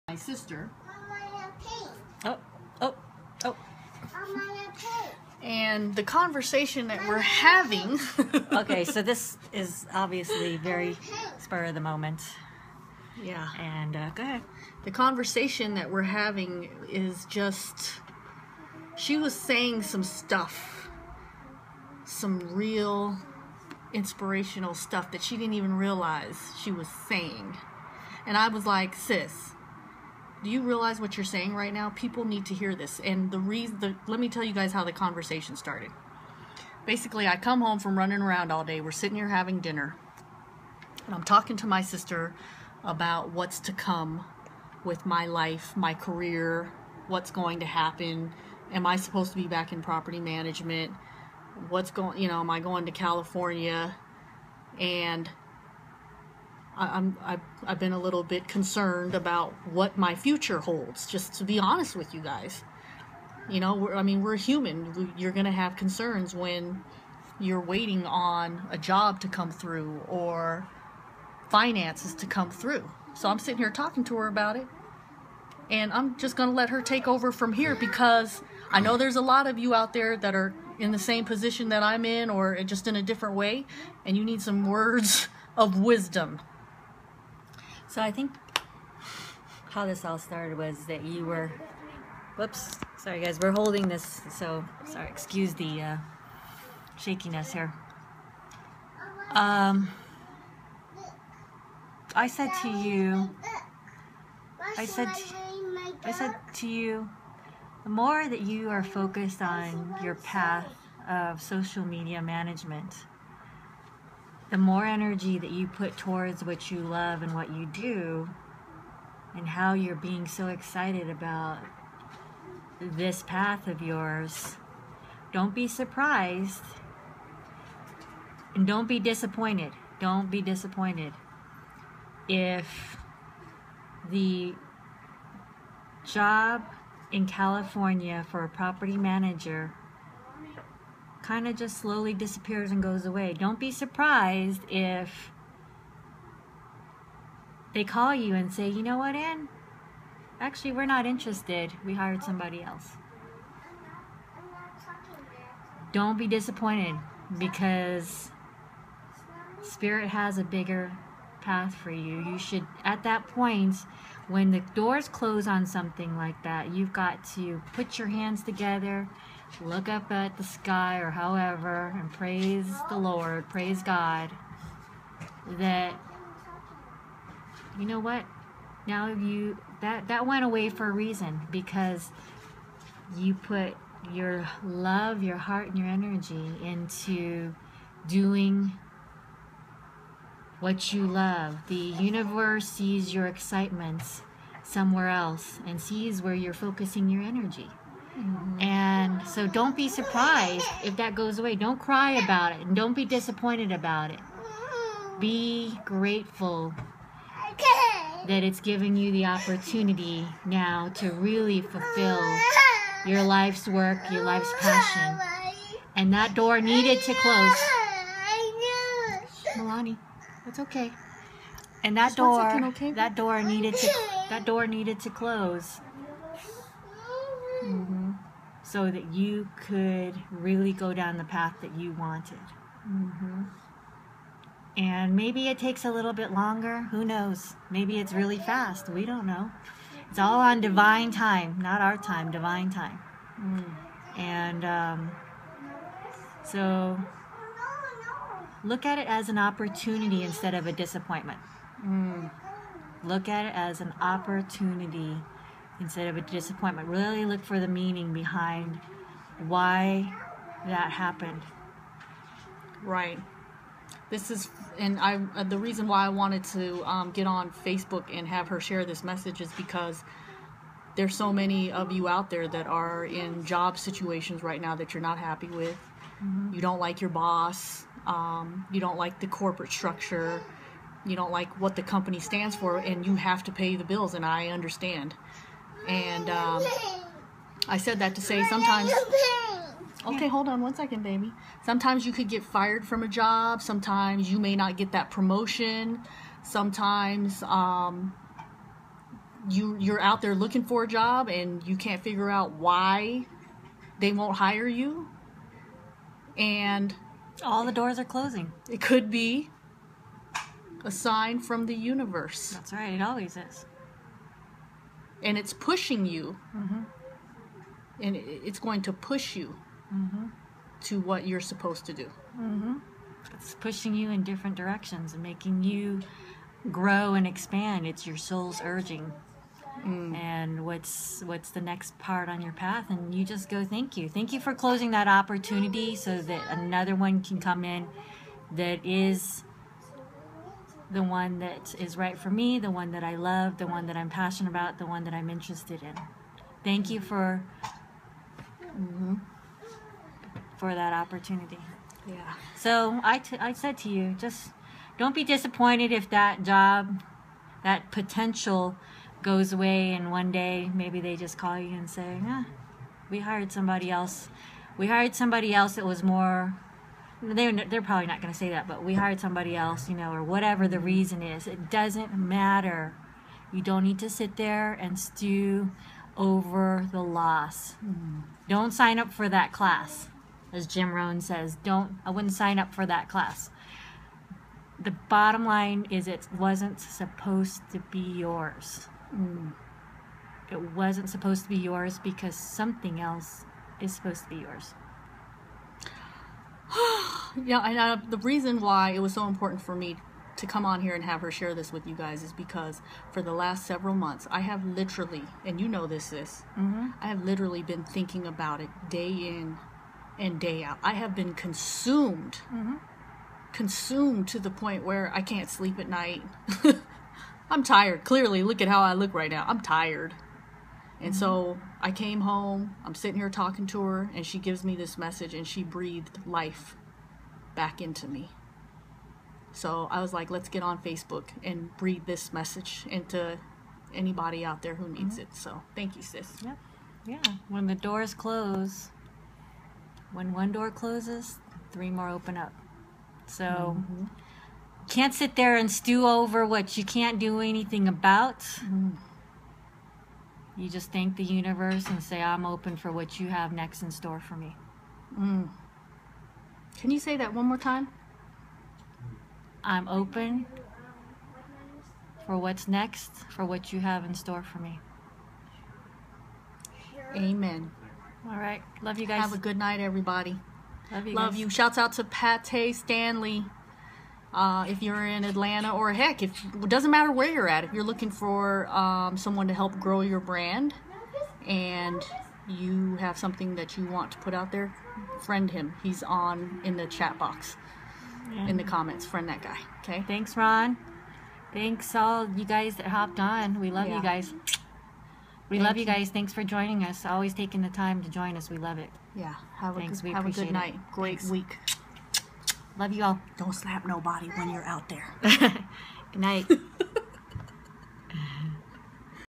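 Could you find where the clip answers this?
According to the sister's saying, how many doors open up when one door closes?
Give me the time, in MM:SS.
07:21.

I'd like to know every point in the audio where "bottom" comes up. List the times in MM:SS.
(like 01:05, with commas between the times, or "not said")
06:24.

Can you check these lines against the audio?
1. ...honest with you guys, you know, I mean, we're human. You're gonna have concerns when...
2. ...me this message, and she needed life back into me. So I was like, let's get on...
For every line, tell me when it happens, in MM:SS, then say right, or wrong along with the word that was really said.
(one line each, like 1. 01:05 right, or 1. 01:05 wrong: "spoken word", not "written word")
1. 01:01 right
2. 07:04 wrong: "breathed", not "needed".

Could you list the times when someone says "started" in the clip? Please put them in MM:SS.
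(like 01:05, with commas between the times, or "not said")
00:35, 01:30.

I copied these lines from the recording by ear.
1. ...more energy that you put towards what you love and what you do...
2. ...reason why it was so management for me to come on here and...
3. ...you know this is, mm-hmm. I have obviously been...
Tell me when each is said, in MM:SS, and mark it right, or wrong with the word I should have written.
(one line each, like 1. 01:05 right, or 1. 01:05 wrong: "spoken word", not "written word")
1. 01:54 right
2. 06:38 wrong: "important", not "management"
3. 06:45 wrong: "literally", not "obviously".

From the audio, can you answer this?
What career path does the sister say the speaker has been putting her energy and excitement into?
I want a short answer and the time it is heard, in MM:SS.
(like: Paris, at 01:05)
social media management, at 01:51.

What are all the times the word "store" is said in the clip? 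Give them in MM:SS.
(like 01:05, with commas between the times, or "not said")
07:33, 07:44.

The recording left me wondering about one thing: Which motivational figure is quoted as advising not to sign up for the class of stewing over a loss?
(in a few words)
Jim Rohn.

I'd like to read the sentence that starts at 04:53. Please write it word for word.
Sometimes you may not get that promotion.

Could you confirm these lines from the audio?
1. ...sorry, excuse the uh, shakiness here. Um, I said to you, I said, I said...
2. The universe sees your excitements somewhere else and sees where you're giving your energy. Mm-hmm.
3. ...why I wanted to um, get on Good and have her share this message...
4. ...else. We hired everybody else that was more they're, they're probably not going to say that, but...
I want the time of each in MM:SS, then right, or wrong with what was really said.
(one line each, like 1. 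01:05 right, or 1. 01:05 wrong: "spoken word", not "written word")
1. 01:34 right
2. 03:11 wrong: "focusing", not "giving"
3. 04:25 wrong: "Facebook", not "Good"
4. 06:03 wrong: "somebody", not "everybody".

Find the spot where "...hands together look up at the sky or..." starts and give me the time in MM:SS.
02:48.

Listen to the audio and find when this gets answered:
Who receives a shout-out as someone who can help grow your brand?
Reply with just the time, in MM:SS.
07:52.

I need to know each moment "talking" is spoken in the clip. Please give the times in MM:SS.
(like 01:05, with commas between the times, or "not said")
00:41, 01:13, 07:03.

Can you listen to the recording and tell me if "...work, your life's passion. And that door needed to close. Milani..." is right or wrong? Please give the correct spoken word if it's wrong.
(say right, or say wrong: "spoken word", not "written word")
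right.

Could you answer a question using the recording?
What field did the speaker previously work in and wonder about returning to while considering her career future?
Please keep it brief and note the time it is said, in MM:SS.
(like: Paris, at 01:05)
property management, at 00:49.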